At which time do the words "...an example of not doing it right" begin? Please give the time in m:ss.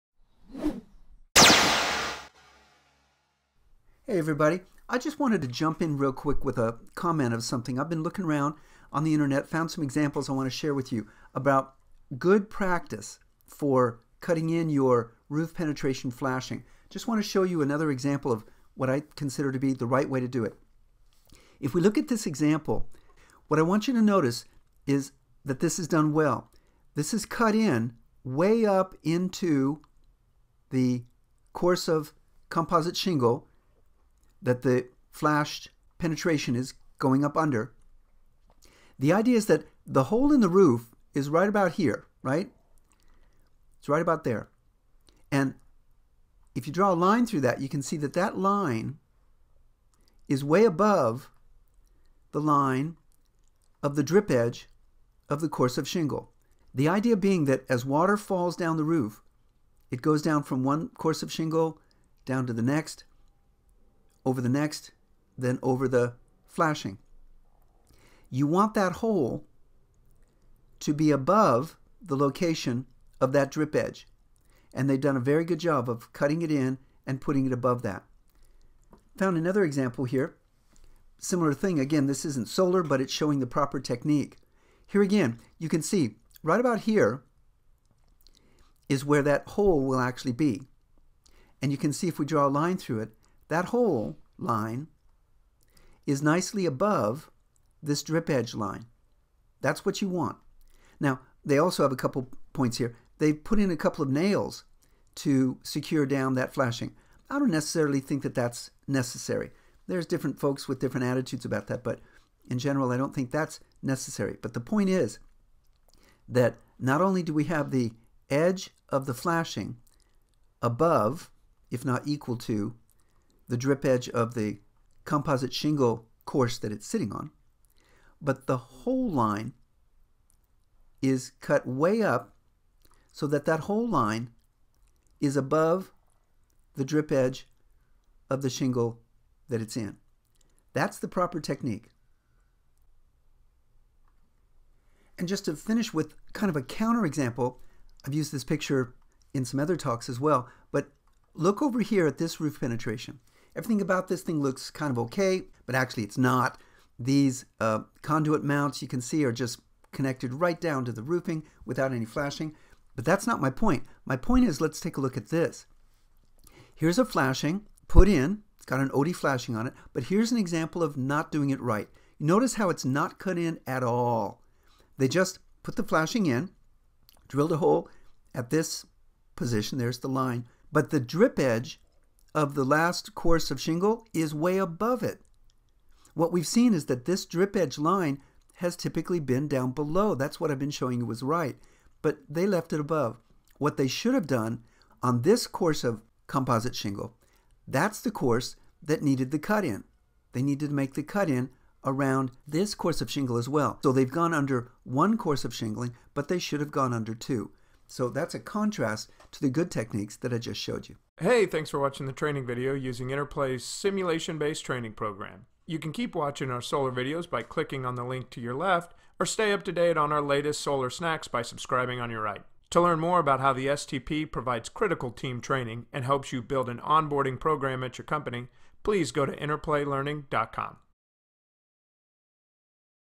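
2:50.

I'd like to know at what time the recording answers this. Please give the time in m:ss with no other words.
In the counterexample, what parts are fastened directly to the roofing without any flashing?
2:38.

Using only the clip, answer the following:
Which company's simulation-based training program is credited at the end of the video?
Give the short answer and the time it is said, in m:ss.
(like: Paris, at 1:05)
Interplay, at 3:33.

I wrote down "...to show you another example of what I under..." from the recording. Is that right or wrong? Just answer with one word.
wrong.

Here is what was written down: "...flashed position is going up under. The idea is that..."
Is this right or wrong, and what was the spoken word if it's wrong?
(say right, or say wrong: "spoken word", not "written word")
wrong: "penetration", not "position".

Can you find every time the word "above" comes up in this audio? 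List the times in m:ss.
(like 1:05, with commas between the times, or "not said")
0:50, 1:11, 1:17, 1:36, 2:00, 2:15, 3:04, 3:12.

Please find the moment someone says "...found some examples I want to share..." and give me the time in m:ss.
0:09.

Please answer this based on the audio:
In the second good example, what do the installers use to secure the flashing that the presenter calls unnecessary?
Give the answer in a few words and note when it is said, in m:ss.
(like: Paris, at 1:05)
A couple of nails, at 1:43.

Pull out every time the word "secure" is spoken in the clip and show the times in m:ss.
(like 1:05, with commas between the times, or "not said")
1:45.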